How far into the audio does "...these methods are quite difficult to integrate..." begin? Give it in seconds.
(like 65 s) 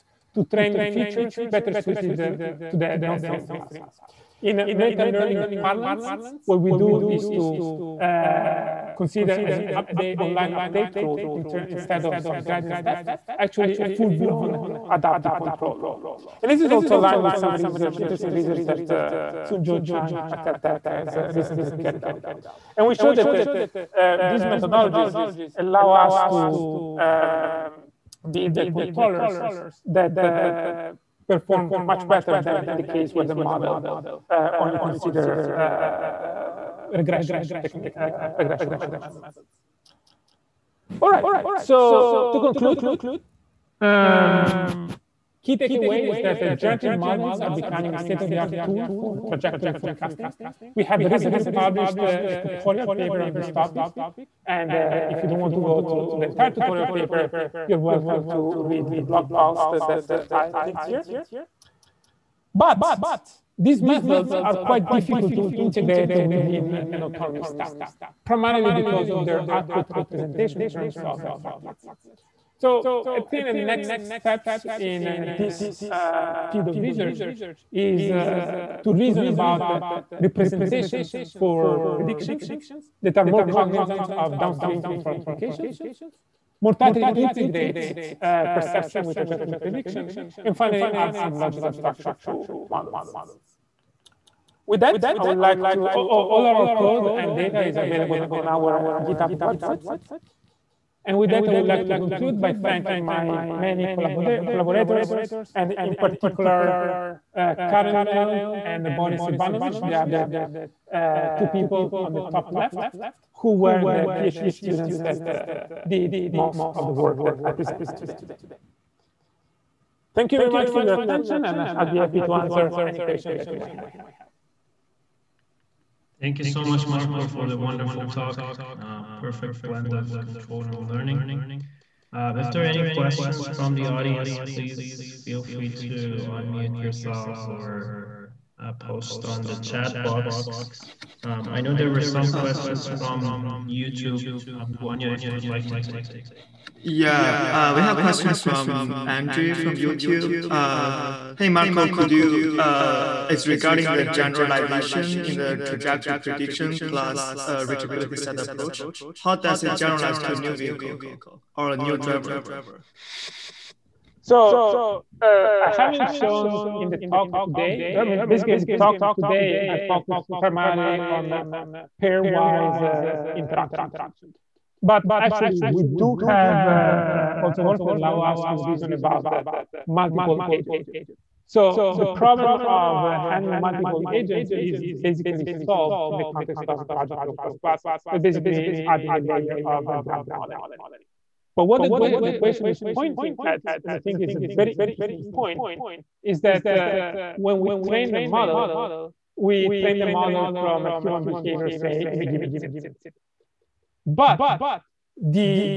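63 s.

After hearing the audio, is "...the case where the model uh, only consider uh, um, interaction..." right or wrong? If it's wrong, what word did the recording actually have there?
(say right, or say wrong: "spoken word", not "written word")
wrong: "regression", not "interaction".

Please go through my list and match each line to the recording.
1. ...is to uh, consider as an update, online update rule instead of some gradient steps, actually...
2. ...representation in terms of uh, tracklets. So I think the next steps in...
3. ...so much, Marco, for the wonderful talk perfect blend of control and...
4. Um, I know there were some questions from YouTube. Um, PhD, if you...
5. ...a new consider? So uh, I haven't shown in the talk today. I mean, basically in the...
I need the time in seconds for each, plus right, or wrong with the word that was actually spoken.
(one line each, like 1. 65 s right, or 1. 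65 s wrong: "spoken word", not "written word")
1. 7 s right
2. 69 s right
3. 126 s right
4. 141 s wrong: "Guanya", not "PhD"
5. 161 s wrong: "driver", not "consider".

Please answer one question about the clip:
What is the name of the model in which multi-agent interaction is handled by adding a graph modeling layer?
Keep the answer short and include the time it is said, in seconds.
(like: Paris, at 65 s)
Trajectron++, at 186 s.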